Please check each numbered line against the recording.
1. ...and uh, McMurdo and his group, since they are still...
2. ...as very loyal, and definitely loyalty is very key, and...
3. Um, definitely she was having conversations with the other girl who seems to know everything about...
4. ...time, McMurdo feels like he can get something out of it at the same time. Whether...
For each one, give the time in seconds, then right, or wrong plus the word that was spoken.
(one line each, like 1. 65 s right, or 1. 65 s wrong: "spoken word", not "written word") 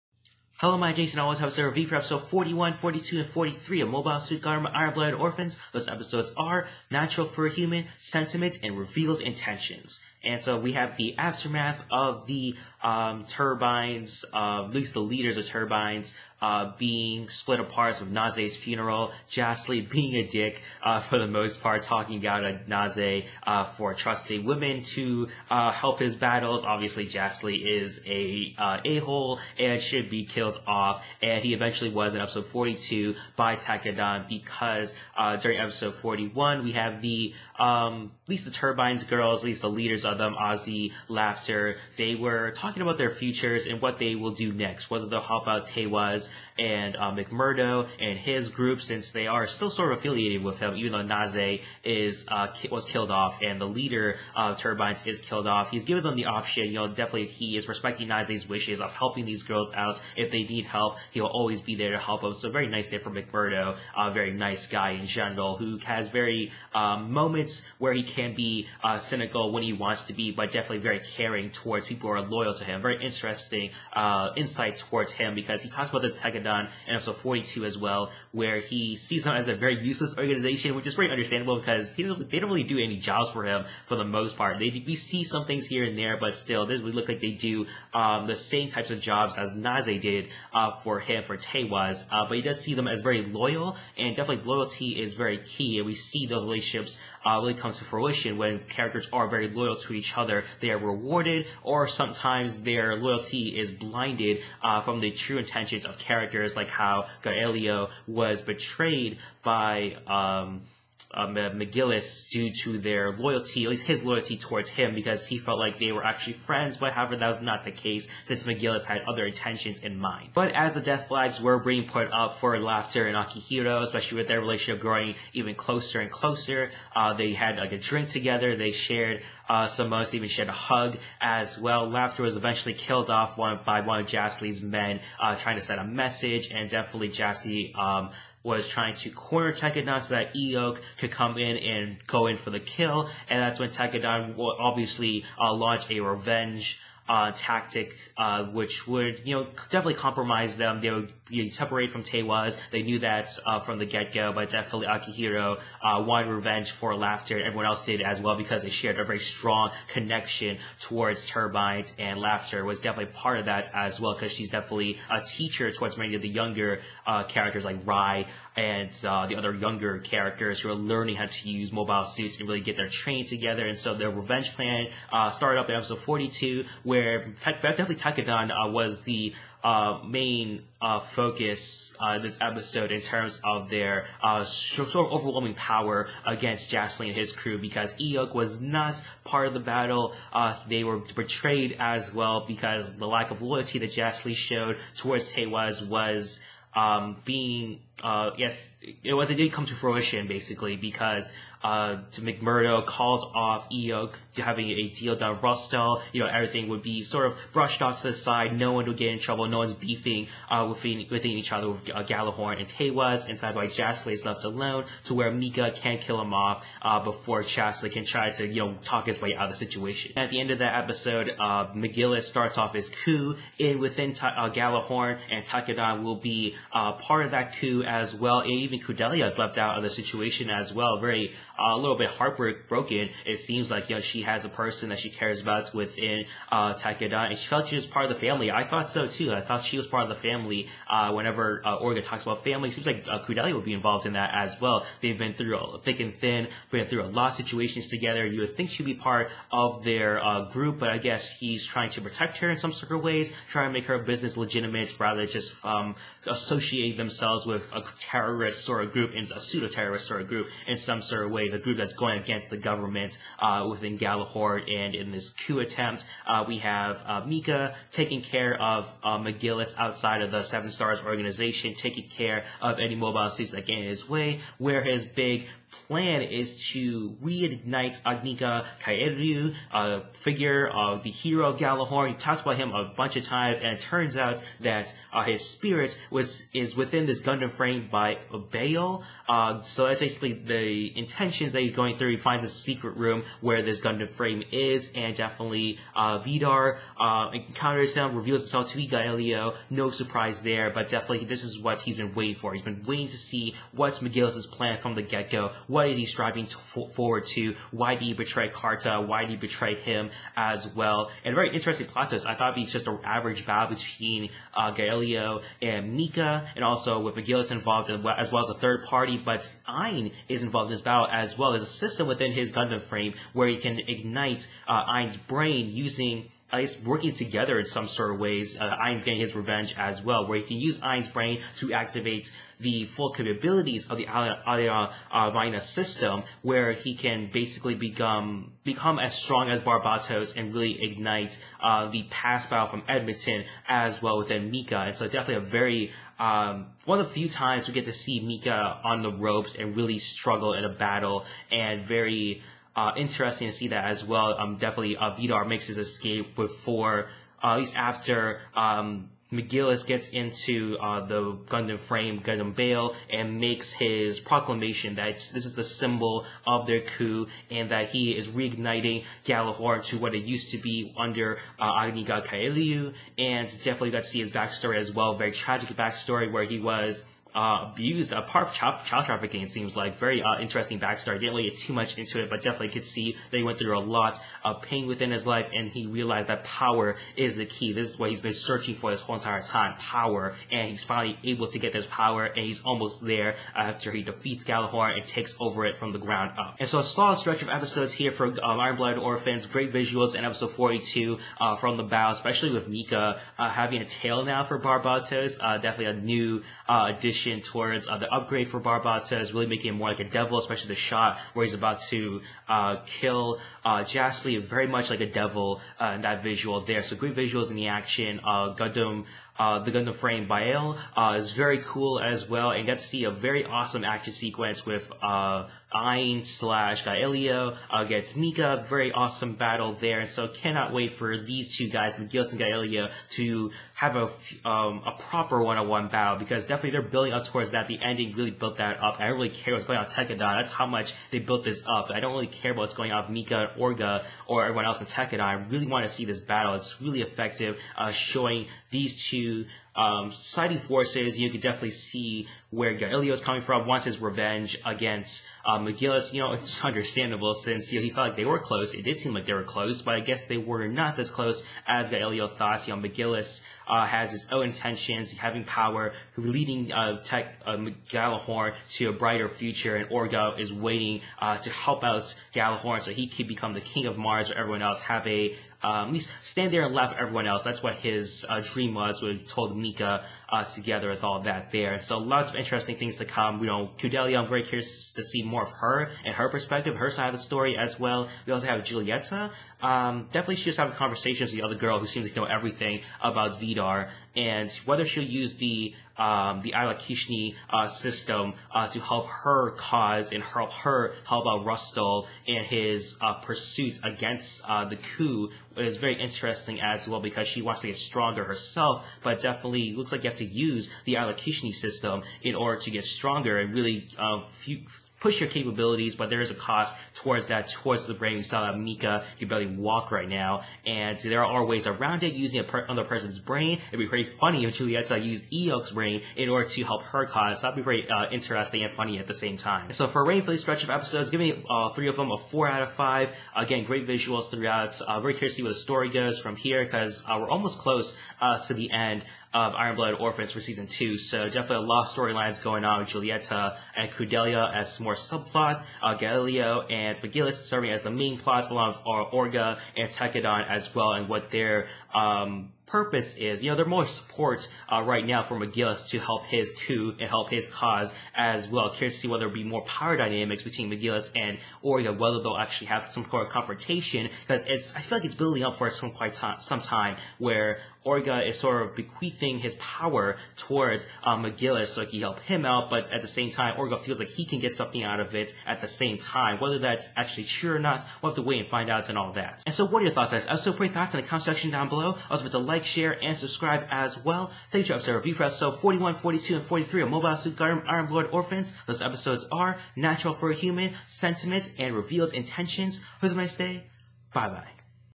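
1. 46 s right
2. 92 s right
3. 489 s right
4. 573 s wrong: "Orga", not "McMurdo".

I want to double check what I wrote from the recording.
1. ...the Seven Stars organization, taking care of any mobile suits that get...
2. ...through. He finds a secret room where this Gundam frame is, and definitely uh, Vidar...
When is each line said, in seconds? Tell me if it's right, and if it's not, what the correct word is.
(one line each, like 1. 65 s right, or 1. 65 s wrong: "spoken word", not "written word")
1. 270 s right
2. 291 s right.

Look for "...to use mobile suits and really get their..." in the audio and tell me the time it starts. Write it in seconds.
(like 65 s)
171 s.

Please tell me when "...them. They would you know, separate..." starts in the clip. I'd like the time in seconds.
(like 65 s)
150 s.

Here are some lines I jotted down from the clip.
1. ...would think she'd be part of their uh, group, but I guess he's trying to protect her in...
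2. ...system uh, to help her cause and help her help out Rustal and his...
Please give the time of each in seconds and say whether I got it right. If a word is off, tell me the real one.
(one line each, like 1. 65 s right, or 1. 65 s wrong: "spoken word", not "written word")
1. 248 s right
2. 497 s right.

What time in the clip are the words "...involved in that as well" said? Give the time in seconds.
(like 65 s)
243 s.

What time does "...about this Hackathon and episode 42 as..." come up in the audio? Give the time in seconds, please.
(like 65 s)
75 s.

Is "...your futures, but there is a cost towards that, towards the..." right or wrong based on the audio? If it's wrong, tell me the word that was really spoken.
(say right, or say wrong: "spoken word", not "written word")
wrong: "capabilities", not "futures".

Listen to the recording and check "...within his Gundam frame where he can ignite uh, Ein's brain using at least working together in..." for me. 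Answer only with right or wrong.
right.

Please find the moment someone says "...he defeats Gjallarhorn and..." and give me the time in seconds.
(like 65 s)
393 s.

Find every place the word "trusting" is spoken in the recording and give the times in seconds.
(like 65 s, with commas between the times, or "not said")
23 s.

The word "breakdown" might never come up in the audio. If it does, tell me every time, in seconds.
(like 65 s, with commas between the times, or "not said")
not said.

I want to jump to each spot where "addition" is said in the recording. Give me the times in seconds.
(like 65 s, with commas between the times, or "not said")
406 s.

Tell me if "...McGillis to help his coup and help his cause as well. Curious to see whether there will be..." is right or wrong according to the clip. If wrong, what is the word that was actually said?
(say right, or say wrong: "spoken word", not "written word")
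right.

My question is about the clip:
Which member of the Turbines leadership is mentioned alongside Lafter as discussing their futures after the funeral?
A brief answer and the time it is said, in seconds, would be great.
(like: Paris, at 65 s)
Azee, at 40 s.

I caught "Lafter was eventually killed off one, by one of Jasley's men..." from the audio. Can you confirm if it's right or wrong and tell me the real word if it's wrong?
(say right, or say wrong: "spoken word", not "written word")
right.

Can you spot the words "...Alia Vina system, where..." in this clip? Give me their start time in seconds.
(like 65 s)
334 s.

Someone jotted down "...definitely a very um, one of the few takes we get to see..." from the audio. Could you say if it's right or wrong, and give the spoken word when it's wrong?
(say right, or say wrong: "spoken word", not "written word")
wrong: "times", not "takes".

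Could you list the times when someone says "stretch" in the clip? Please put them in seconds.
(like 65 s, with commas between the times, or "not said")
397 s, 530 s.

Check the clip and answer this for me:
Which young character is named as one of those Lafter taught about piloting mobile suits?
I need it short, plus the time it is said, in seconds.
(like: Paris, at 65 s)
Rai, at 167 s.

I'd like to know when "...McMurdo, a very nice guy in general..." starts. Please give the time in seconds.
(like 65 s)
63 s.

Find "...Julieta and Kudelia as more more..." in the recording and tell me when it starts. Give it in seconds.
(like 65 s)
542 s.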